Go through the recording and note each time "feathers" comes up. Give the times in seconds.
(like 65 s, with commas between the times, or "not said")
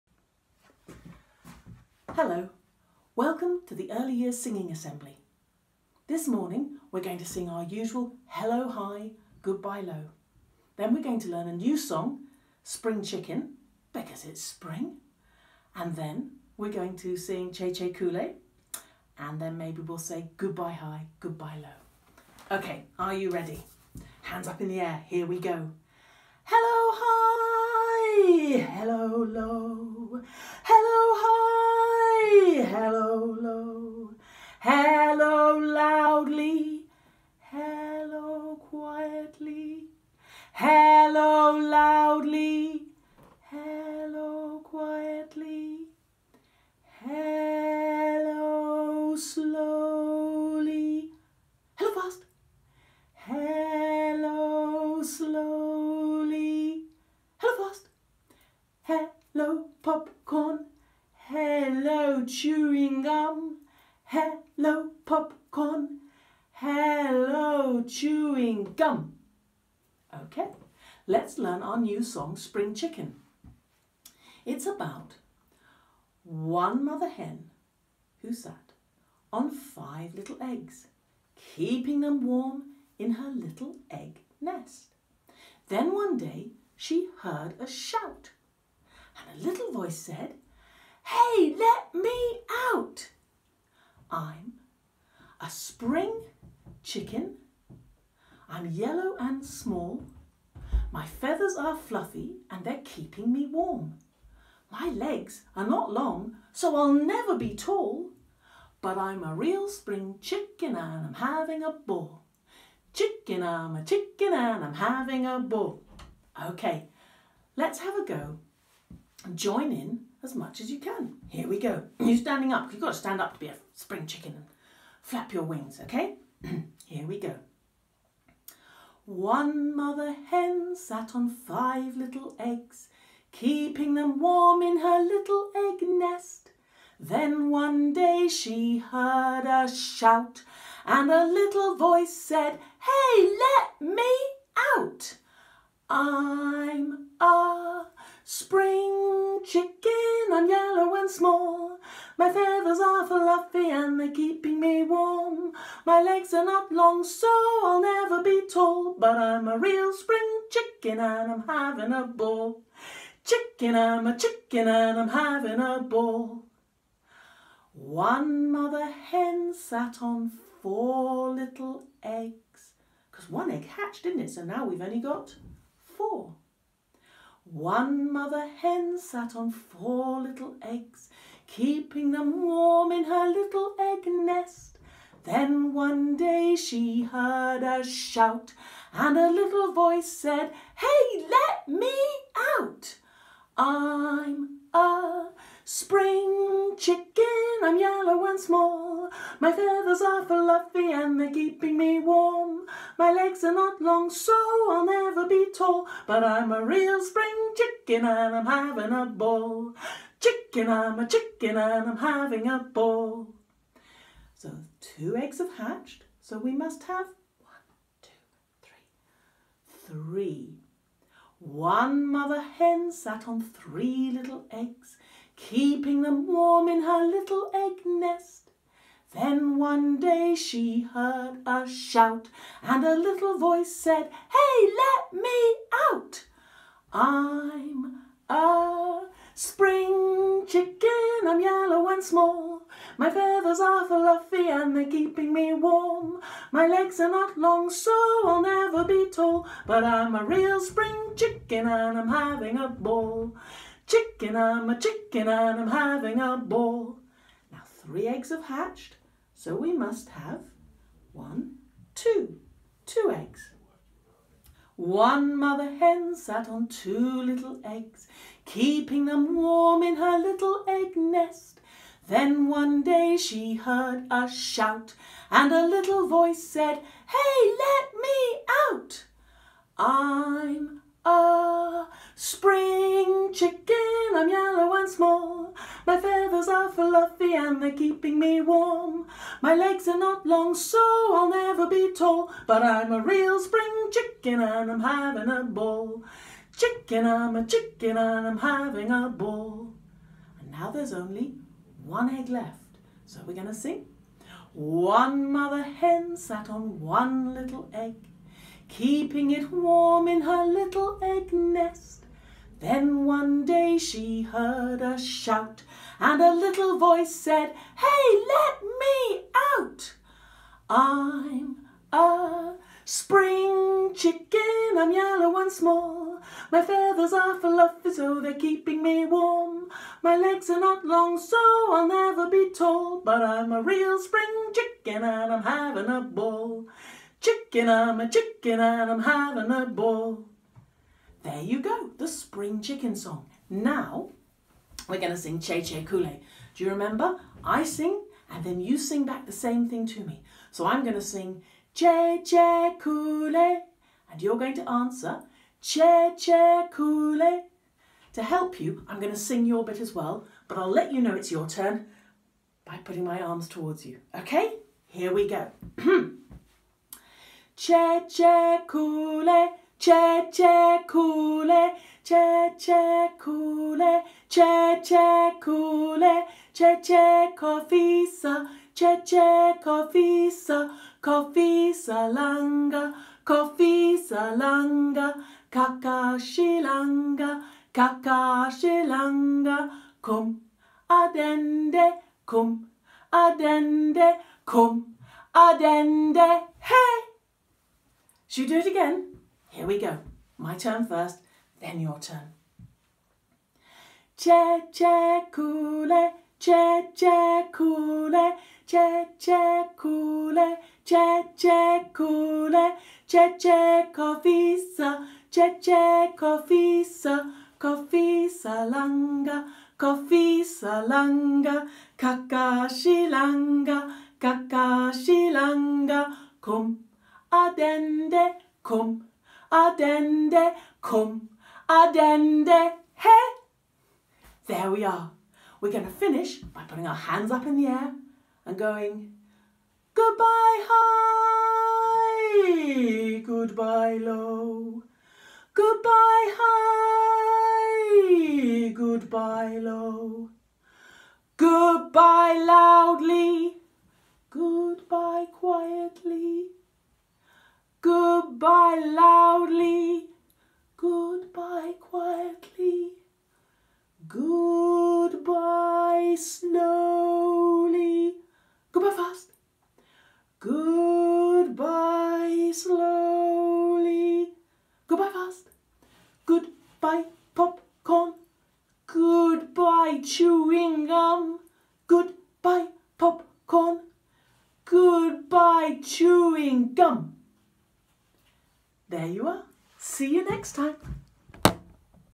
101 s, 152 s, 199 s, 243 s, 285 s, 326 s.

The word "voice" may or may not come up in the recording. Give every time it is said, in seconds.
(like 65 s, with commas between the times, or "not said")
89 s, 141 s, 189 s, 233 s, 276 s, 316 s.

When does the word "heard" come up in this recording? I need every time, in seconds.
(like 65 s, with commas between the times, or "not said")
87 s, 138 s, 187 s, 230 s, 273 s, 314 s.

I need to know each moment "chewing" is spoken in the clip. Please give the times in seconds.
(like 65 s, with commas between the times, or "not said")
62 s, 67 s, 480 s, 485 s.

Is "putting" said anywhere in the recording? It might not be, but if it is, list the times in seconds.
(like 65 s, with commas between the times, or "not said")
362 s, 436 s.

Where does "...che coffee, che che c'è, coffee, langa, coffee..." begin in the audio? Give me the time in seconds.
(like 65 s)
413 s.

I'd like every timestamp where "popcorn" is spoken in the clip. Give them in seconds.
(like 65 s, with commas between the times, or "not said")
59 s, 65 s, 477 s, 482 s.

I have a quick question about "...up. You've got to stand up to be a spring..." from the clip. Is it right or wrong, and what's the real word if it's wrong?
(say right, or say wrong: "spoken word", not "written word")
right.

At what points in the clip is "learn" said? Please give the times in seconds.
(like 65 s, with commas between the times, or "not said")
11 s, 71 s.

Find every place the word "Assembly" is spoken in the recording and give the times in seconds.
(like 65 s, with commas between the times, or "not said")
4 s.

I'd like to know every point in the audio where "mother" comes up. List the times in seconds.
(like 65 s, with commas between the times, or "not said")
76 s, 129 s, 168 s, 178 s, 222 s, 265 s, 305 s.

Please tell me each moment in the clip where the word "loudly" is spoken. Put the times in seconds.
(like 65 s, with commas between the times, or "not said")
452 s, 458 s.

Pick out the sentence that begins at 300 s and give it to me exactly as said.
And now there's only one egg left.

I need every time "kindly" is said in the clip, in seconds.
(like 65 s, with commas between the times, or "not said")
not said.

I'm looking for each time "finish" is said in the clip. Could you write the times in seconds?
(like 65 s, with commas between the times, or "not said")
435 s.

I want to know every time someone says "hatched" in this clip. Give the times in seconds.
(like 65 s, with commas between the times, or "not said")
173 s, 215 s, 258 s.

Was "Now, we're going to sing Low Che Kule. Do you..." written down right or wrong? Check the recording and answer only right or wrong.
wrong.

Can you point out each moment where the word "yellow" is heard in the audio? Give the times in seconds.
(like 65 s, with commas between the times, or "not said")
98 s, 150 s, 197 s, 241 s, 284 s, 324 s.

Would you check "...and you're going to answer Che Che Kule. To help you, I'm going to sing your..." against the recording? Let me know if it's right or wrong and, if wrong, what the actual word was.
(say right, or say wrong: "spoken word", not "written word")
right.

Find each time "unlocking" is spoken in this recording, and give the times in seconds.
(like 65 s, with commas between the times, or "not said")
not said.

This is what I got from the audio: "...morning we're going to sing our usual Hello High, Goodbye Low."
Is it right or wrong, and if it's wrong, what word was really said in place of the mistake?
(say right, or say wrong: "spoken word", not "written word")
right.